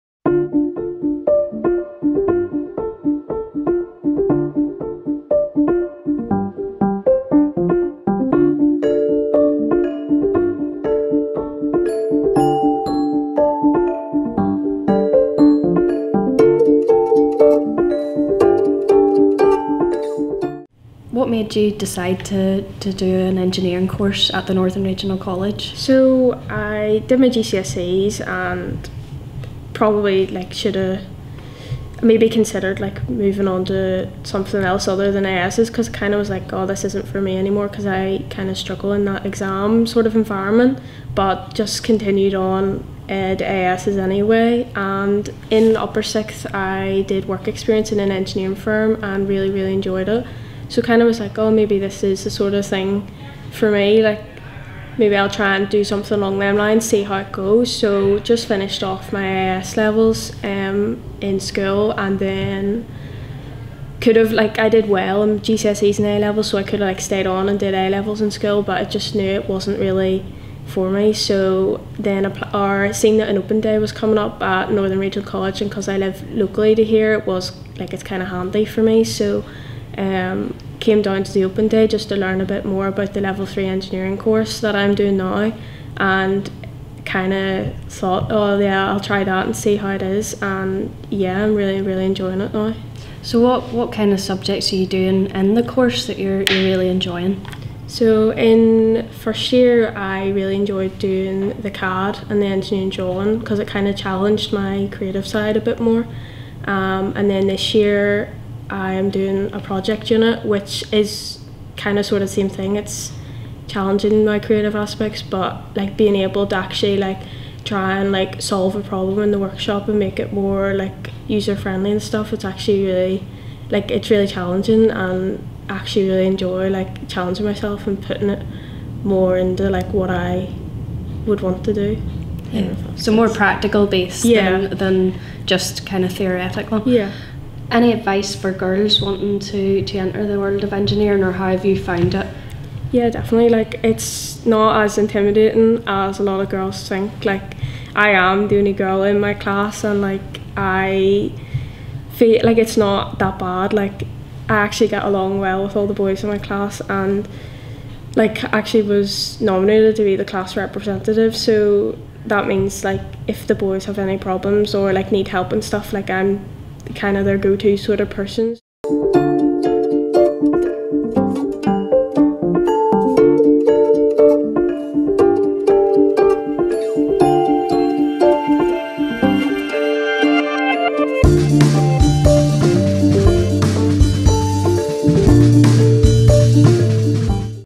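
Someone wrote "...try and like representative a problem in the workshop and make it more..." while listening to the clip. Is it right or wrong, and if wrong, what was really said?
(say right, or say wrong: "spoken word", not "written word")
wrong: "solve", not "representative".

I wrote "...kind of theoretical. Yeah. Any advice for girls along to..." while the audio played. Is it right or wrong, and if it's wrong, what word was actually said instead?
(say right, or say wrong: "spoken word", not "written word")
wrong: "wanting", not "along".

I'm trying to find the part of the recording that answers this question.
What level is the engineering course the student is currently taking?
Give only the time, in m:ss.
1:23.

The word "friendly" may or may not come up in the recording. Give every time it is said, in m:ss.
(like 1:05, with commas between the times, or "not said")
2:01.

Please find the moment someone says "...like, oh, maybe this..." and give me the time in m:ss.
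0:51.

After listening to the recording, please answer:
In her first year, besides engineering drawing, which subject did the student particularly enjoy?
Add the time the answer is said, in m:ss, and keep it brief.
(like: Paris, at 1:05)
CAD, at 1:41.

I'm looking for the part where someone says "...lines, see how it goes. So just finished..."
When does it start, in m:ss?
0:56.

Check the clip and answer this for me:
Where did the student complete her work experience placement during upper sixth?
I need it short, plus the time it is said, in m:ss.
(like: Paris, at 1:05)
An engineering firm, at 0:48.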